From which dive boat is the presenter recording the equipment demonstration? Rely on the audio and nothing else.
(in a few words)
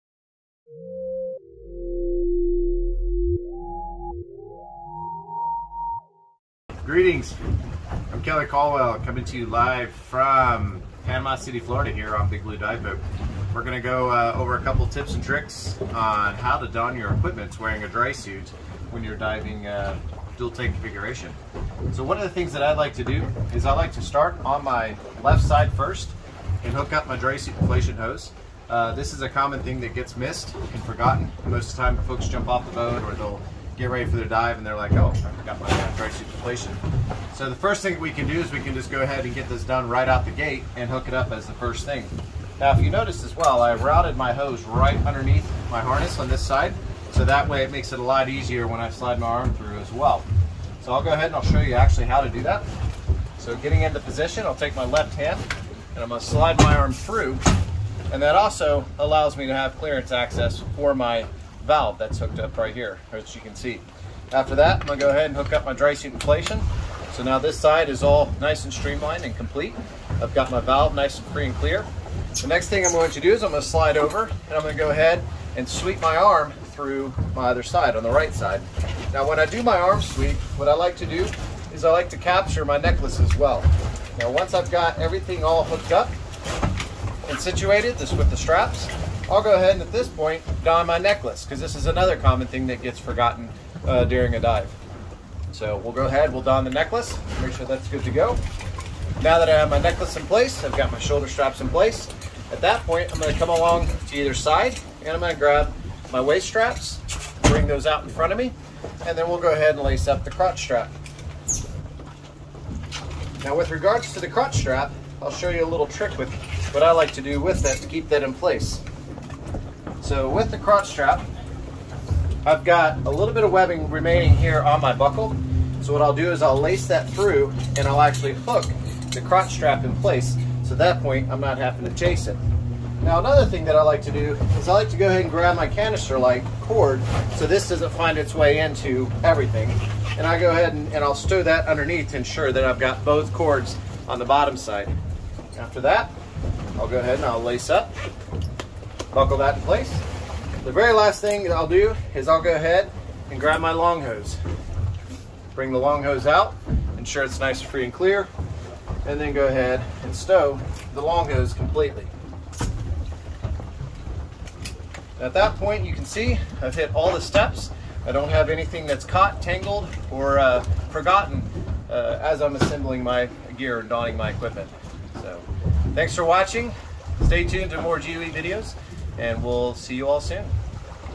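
Big Blue.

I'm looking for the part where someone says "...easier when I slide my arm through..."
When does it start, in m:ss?
0:48.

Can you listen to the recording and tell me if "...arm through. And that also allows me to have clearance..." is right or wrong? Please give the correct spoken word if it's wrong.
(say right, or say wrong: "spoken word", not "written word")
right.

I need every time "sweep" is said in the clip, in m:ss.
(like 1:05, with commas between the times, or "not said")
1:15, 1:20.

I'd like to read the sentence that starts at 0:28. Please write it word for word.
Uh, this is a common thing that gets missed and forgotten.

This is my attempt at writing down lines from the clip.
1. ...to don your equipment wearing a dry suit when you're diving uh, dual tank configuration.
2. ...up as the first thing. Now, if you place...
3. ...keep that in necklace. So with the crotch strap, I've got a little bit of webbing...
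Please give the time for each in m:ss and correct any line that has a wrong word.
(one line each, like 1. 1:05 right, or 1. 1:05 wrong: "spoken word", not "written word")
1. 0:16 right
2. 0:41 wrong: "notice", not "place"
3. 1:57 wrong: "place", not "necklace".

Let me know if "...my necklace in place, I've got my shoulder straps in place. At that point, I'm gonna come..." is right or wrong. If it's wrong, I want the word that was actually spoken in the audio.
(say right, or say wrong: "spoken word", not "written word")
right.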